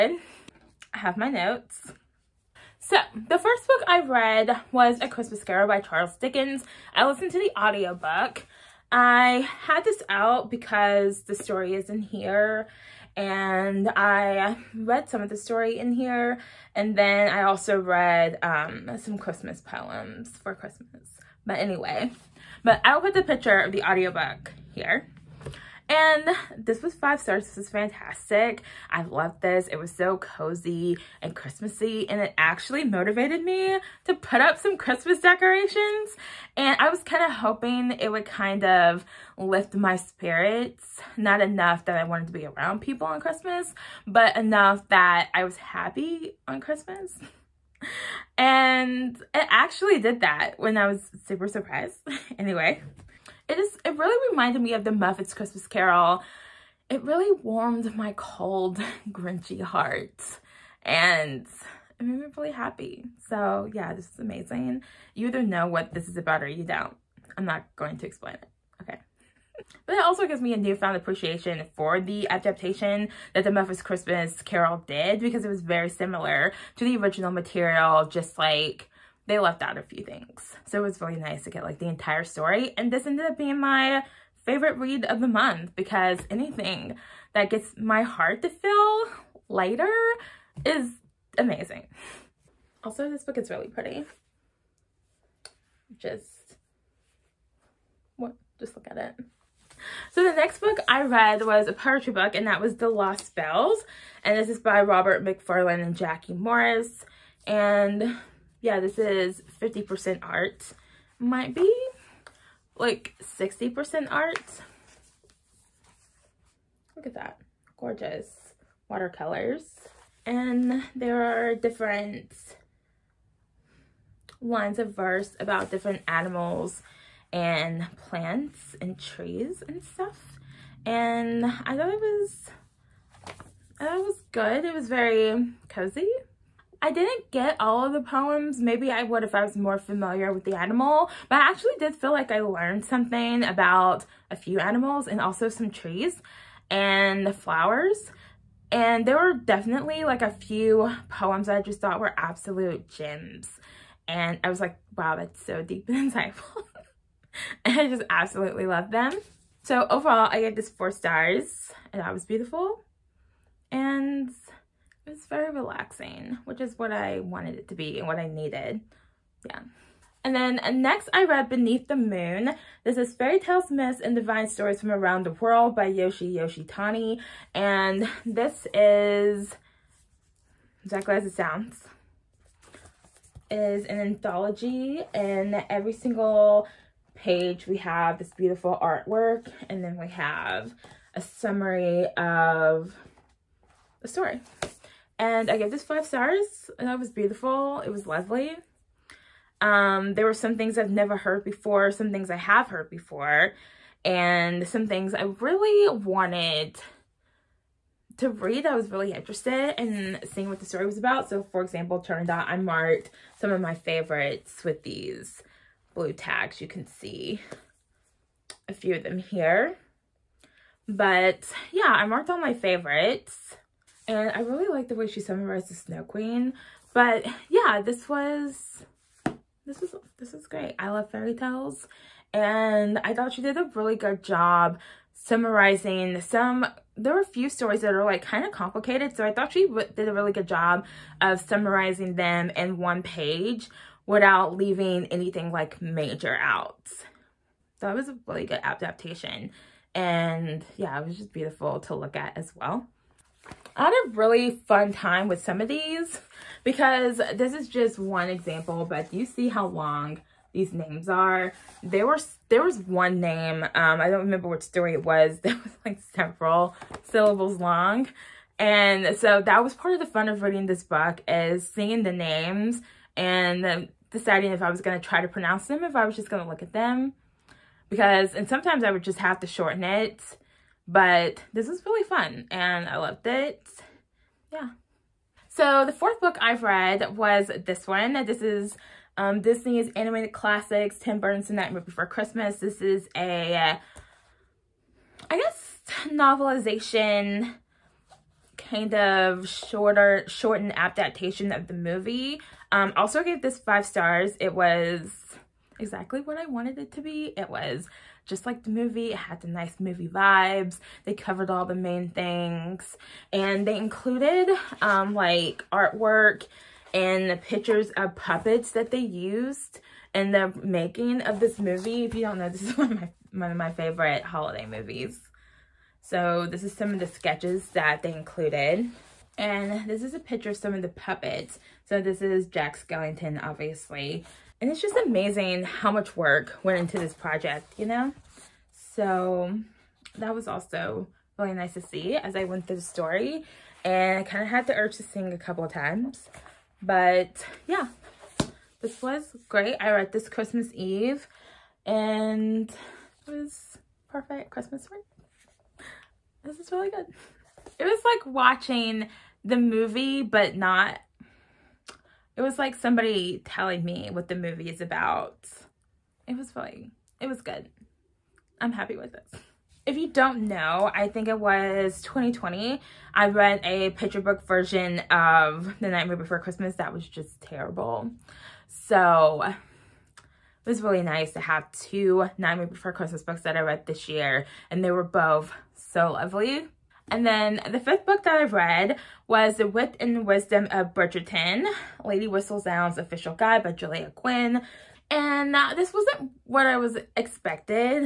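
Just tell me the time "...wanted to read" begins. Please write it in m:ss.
3:25.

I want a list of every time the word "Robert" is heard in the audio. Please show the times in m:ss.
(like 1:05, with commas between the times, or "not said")
1:44.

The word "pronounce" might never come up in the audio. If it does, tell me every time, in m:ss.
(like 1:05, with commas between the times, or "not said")
4:35.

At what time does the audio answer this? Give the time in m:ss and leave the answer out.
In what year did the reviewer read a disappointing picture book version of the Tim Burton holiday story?
6:12.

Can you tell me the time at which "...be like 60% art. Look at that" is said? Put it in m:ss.
1:51.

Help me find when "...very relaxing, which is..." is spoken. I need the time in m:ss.
2:45.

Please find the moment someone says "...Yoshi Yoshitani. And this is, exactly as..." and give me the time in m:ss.
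2:55.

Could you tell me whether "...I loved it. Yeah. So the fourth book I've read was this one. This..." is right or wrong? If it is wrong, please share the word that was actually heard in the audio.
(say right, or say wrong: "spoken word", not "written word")
right.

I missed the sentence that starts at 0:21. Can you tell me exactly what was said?
But anyway, but I'll put the picture of the audiobook here.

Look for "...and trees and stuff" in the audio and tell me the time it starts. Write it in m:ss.
2:08.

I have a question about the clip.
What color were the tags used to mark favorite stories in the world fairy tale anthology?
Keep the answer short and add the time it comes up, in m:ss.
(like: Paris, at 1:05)
Blue, at 3:35.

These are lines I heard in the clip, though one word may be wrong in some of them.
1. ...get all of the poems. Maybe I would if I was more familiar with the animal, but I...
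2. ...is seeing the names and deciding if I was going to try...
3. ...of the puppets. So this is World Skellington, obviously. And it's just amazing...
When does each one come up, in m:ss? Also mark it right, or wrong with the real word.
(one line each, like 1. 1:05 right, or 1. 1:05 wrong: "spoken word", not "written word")
1. 2:17 right
2. 4:31 right
3. 5:30 wrong: "Jack", not "World".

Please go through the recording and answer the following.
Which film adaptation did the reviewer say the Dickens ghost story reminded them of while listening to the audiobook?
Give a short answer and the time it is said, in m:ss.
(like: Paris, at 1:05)
The Muppets Christmas Carol, at 0:54.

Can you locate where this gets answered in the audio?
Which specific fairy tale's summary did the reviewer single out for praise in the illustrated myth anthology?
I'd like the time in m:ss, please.
3:45.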